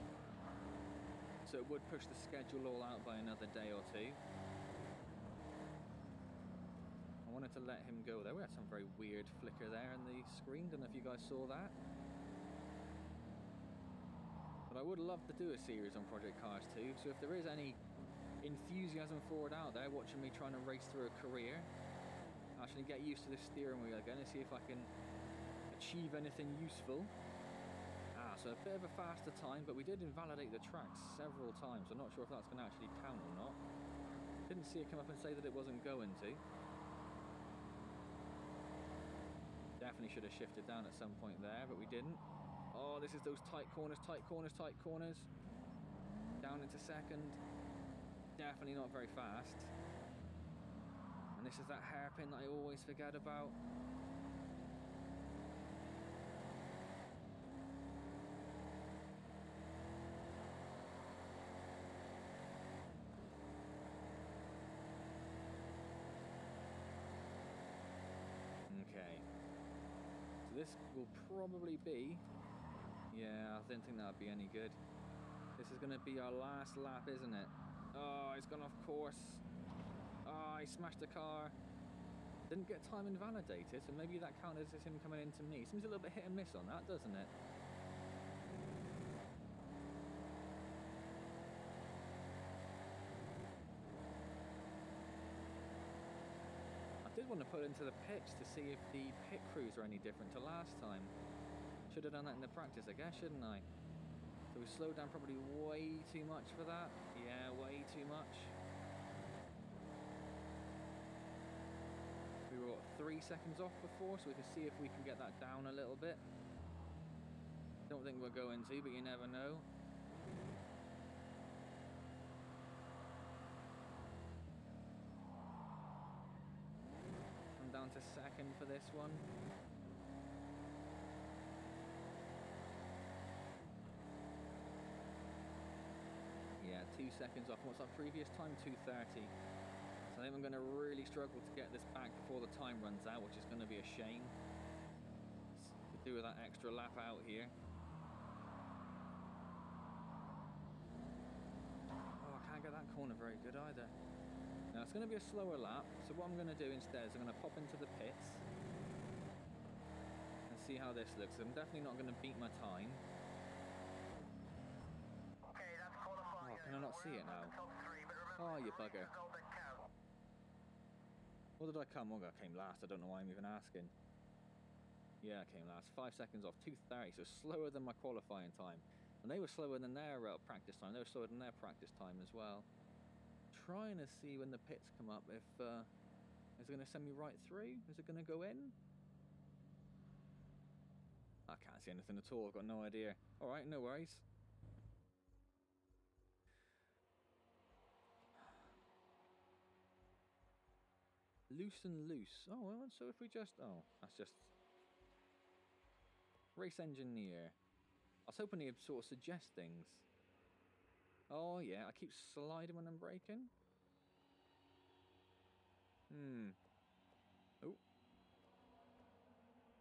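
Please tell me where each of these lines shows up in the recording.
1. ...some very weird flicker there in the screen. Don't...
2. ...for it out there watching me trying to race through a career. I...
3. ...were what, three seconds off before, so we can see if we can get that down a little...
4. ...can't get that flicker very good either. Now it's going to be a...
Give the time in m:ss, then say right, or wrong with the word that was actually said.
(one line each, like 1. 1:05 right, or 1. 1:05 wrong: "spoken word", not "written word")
1. 0:08 right
2. 0:19 right
3. 1:52 right
4. 2:32 wrong: "corner", not "flicker".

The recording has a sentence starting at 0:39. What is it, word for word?
Definitely should have shifted down at some point there, but we didn't.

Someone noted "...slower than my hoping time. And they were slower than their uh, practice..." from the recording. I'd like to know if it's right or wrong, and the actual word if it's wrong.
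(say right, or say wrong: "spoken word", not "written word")
wrong: "qualifying", not "hoping".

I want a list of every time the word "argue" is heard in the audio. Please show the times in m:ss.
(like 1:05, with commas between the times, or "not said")
not said.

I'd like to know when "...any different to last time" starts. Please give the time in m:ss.
1:39.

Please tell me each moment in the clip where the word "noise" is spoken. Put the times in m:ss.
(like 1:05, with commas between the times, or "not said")
not said.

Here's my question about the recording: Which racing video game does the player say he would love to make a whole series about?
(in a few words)
Project Cars 2.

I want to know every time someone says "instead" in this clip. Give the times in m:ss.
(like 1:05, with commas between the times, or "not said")
2:36.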